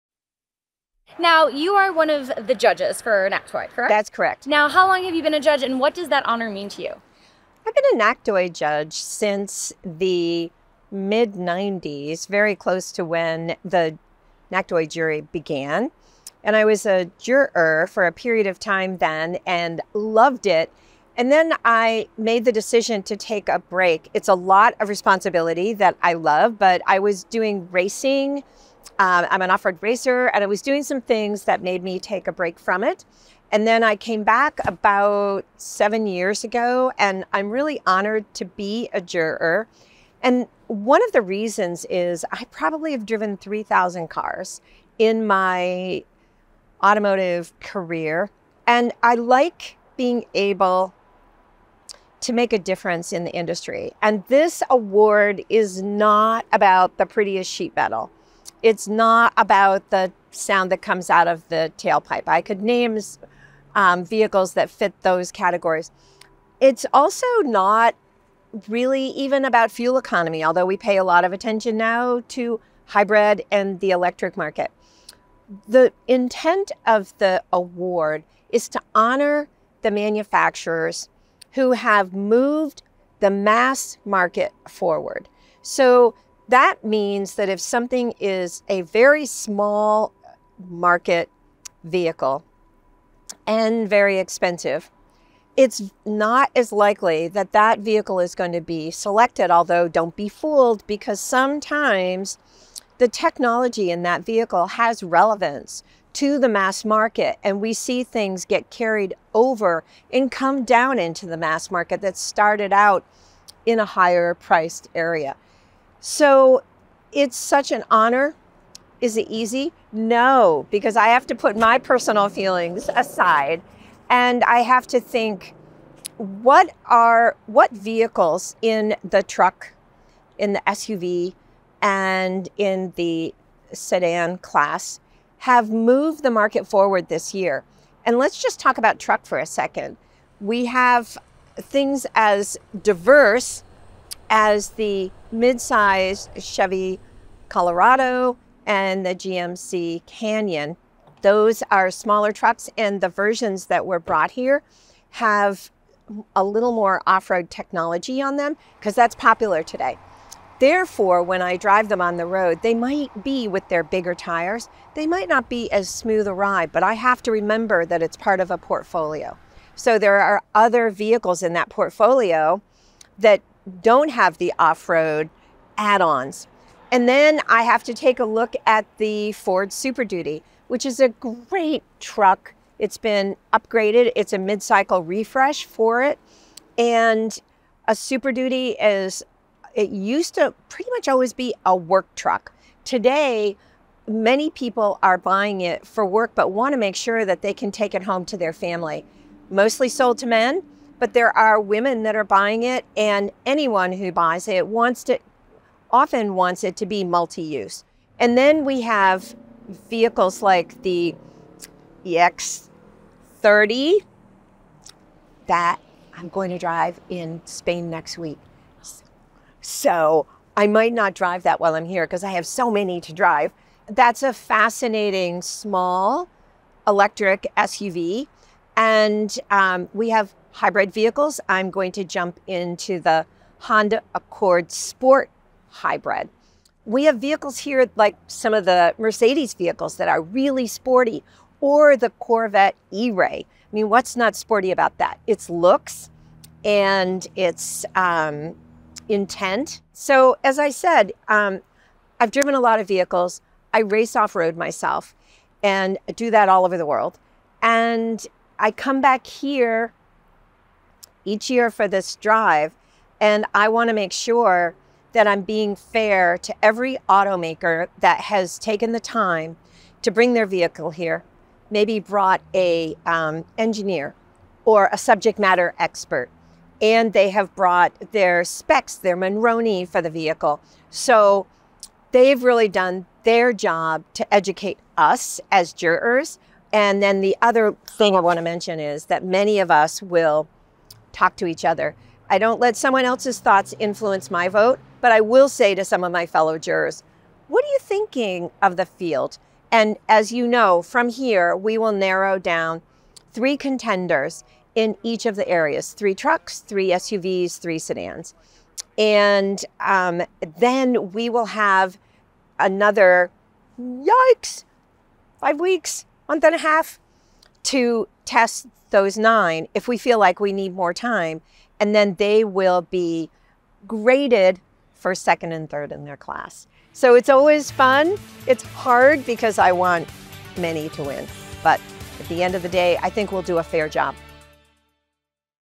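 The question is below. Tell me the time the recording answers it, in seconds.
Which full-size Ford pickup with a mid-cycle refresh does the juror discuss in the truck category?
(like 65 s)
179 s.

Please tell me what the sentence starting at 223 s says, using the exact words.
That's a fascinating small electric SUV.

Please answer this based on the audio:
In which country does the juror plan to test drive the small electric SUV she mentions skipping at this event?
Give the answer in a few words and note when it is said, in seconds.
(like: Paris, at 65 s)
Spain, at 217 s.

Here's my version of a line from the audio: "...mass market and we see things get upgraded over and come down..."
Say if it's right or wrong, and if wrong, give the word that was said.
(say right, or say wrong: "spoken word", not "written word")
wrong: "carried", not "upgraded".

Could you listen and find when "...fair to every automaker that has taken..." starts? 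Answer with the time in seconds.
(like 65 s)
265 s.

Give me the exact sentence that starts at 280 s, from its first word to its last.
So they've really done their job to educate us as jurors.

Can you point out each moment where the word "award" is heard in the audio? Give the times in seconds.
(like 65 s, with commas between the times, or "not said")
54 s, 77 s.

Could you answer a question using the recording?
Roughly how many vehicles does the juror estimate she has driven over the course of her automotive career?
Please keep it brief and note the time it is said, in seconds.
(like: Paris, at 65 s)
3,000, at 43 s.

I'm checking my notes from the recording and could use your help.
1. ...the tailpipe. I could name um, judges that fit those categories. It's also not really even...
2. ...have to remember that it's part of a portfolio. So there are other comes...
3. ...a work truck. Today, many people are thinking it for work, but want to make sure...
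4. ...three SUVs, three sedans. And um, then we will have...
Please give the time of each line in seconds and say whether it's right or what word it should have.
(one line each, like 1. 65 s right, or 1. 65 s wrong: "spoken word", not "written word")
1. 61 s wrong: "vehicles", not "judges"
2. 166 s wrong: "vehicles", not "comes"
3. 191 s wrong: "buying", not "thinking"
4. 306 s right.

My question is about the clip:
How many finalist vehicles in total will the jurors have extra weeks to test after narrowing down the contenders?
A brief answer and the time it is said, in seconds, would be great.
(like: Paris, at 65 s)
9, at 319 s.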